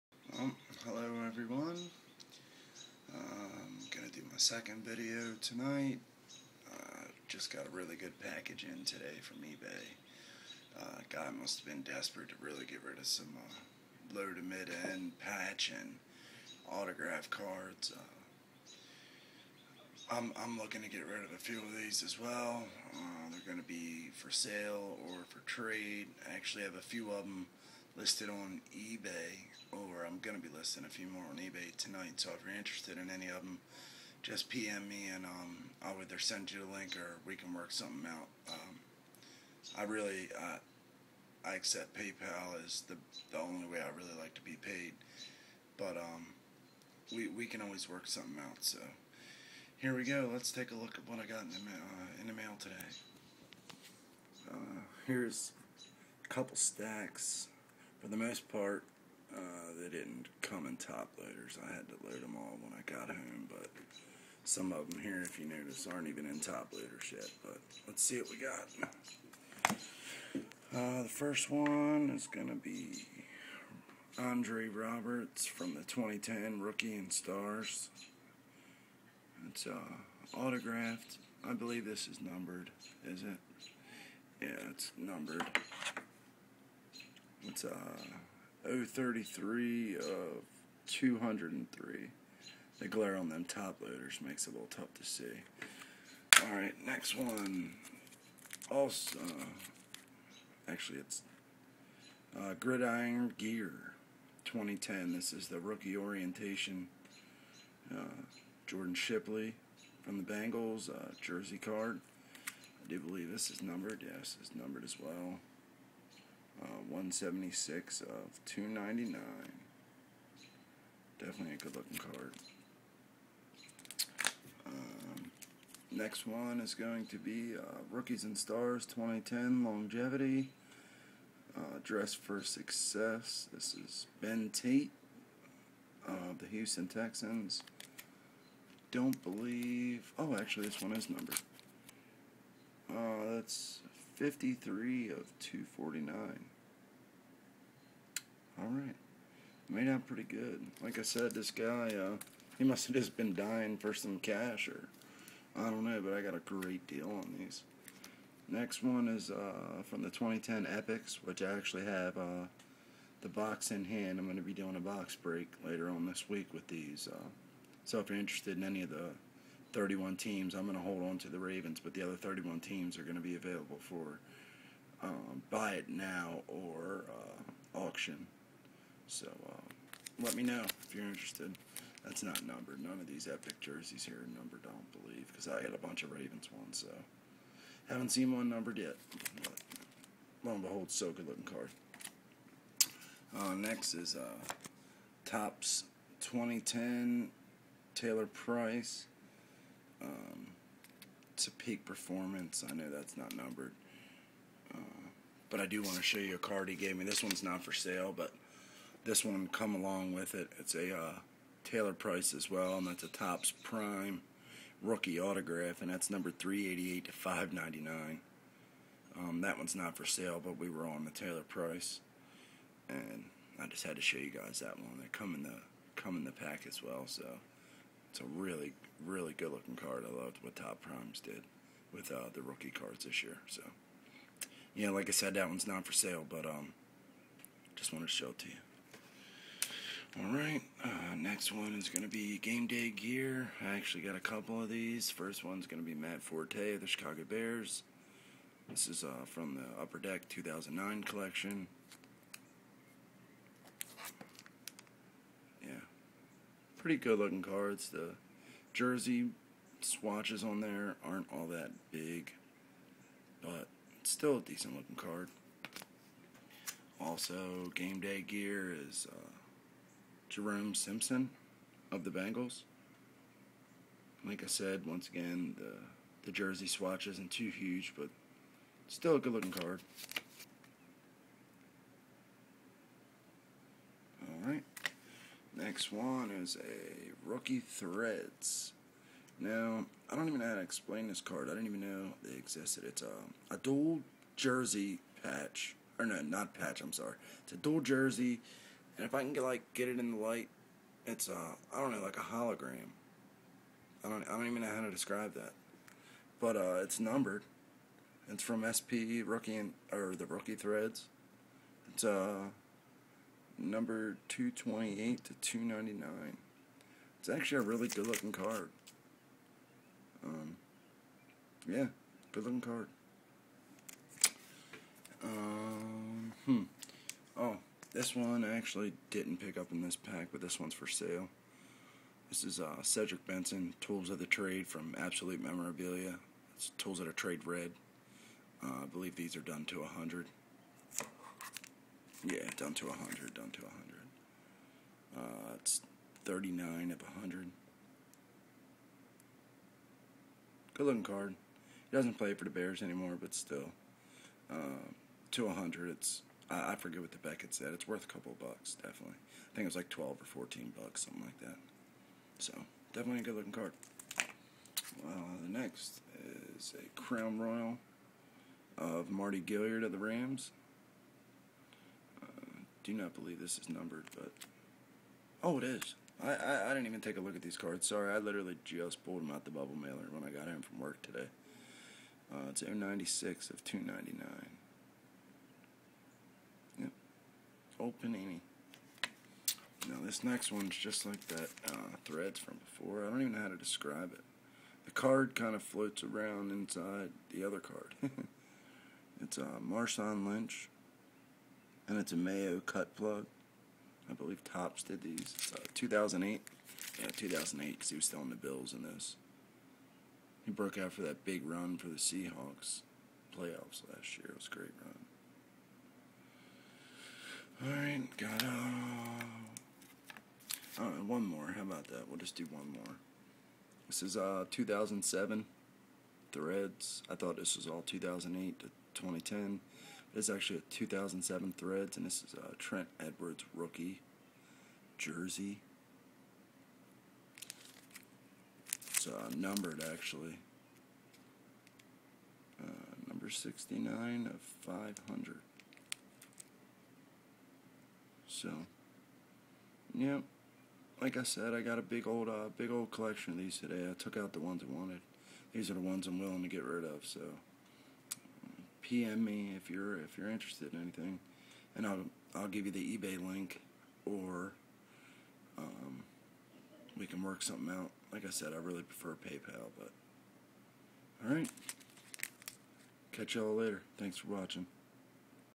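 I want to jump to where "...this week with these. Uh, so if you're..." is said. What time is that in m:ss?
2:46.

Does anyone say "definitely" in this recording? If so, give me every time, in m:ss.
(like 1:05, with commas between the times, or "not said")
2:01, 5:58, 6:02.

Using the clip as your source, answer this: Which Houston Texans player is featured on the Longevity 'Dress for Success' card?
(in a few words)
Ben Tate.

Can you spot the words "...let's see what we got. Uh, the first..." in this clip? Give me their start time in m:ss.
1:07.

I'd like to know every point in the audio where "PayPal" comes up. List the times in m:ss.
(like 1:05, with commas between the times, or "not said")
0:41, 7:49.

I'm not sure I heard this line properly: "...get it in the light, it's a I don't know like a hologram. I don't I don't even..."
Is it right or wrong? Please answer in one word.
right.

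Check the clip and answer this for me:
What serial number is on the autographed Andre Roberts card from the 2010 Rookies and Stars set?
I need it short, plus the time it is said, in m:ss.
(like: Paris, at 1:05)
033 of 203, at 1:28.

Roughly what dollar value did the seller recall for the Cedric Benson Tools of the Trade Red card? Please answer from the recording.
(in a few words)
12 or 14 dollars.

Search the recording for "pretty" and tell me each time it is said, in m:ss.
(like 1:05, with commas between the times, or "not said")
2:30, 4:16.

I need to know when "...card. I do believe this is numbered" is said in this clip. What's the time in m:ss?
1:51.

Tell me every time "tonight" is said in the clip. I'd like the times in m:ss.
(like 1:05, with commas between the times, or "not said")
0:05, 0:31.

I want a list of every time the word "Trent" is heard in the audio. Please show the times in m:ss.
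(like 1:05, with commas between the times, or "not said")
7:12.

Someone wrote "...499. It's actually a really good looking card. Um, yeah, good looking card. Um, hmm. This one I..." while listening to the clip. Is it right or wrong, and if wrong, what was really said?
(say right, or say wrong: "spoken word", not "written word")
wrong: "299", not "499".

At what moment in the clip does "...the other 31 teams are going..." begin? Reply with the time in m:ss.
2:51.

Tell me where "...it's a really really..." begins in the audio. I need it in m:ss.
3:48.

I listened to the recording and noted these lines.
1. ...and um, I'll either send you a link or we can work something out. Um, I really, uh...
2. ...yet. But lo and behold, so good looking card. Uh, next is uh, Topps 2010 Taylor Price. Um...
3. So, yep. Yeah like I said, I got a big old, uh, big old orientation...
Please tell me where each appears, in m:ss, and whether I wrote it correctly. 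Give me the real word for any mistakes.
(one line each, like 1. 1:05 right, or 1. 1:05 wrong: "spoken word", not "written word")
1. 0:35 right
2. 3:08 right
3. 7:28 wrong: "collection", not "orientation".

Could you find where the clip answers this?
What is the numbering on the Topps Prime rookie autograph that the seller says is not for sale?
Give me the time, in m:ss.
3:36.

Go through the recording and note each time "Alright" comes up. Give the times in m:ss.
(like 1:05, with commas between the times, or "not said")
1:36, 4:00, 4:44.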